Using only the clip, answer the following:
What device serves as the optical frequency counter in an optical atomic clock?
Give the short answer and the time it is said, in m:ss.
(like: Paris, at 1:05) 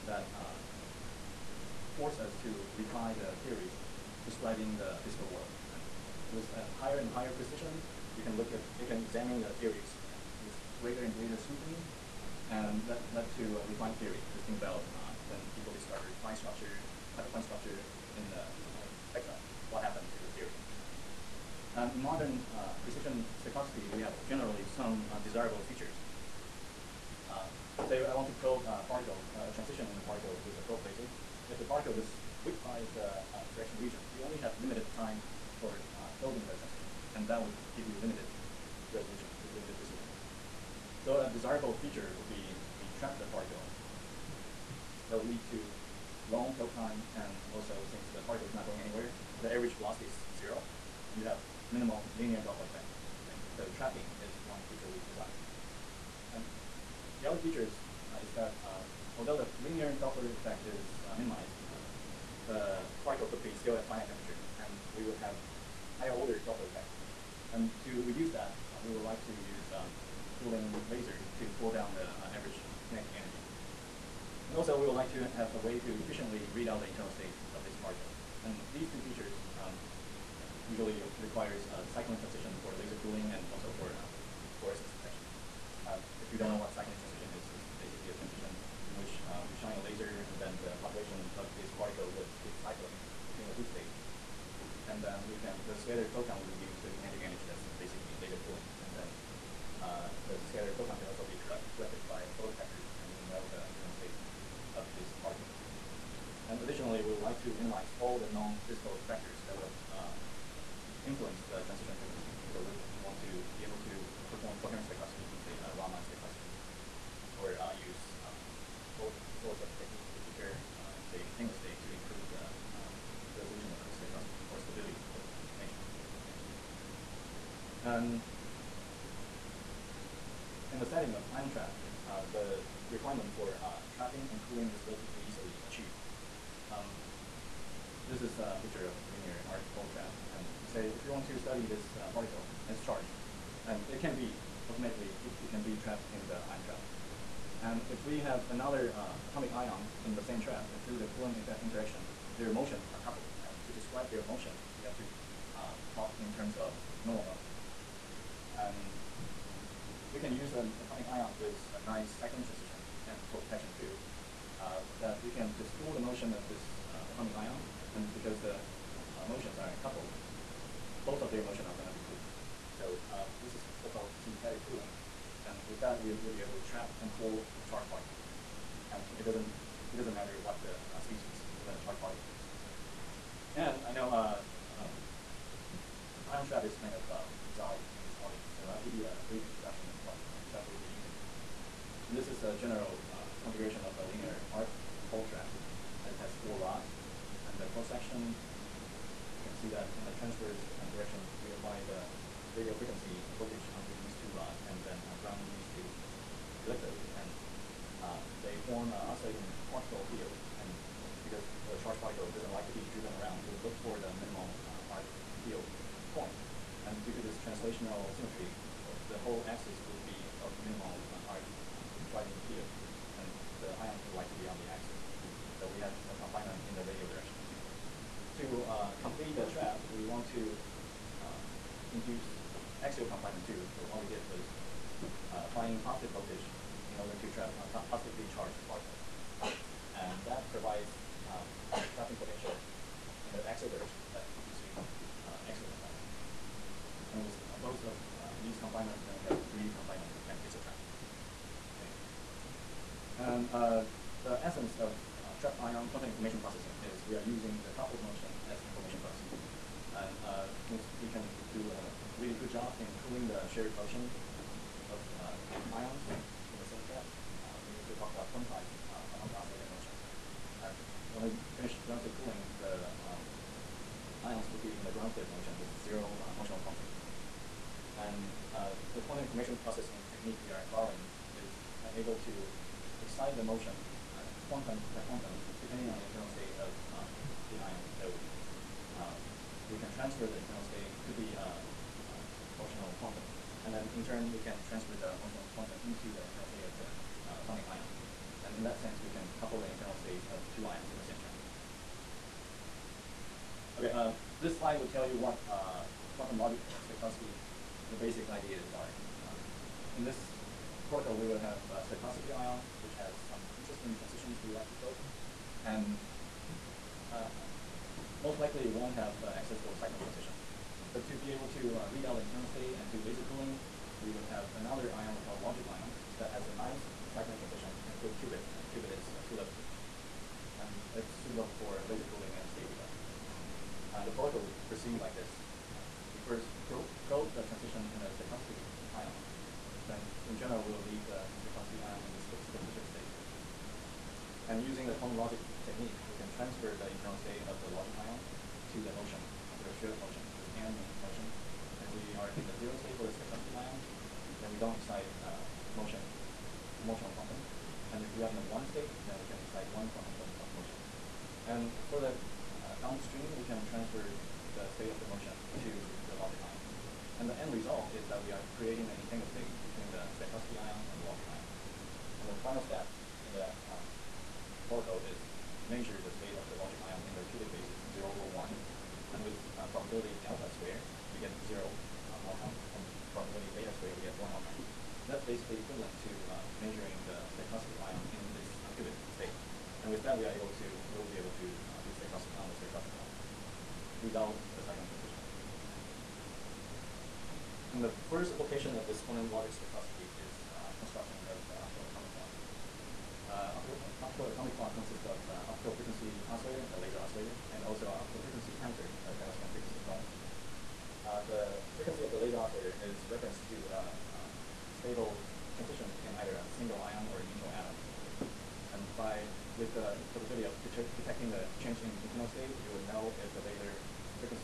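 Femtosecond frequency comb, at 6:49.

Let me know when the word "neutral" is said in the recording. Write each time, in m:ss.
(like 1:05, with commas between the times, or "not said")
6:57.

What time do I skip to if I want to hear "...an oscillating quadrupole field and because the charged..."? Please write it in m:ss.
3:28.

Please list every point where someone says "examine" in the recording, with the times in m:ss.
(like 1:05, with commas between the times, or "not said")
0:09.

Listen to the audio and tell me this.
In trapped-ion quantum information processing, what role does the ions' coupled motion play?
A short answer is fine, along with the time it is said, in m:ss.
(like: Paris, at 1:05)
Information bus, at 4:18.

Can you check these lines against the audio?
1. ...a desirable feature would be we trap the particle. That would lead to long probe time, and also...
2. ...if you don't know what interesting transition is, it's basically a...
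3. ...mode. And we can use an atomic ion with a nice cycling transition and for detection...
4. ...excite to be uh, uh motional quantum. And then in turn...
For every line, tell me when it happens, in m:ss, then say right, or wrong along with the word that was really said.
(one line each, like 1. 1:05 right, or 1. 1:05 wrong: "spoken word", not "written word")
1. 0:41 right
2. 1:26 wrong: "cycling", not "interesting"
3. 2:37 right
4. 4:50 wrong: "state", not "excite".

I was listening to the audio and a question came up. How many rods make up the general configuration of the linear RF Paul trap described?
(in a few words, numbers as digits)
4.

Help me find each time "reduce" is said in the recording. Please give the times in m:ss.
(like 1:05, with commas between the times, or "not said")
1:08, 1:36.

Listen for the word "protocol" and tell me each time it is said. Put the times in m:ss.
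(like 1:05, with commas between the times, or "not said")
5:10, 5:34, 6:14.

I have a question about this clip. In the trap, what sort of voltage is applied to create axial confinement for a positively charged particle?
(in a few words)
Positive voltage.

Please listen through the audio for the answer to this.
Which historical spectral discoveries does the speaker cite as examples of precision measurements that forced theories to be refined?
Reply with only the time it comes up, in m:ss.
0:16.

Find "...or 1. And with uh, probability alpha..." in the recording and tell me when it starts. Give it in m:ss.
6:18.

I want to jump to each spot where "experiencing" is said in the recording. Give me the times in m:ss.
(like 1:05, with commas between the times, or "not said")
not said.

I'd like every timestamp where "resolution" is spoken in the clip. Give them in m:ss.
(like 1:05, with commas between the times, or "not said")
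0:38, 2:03.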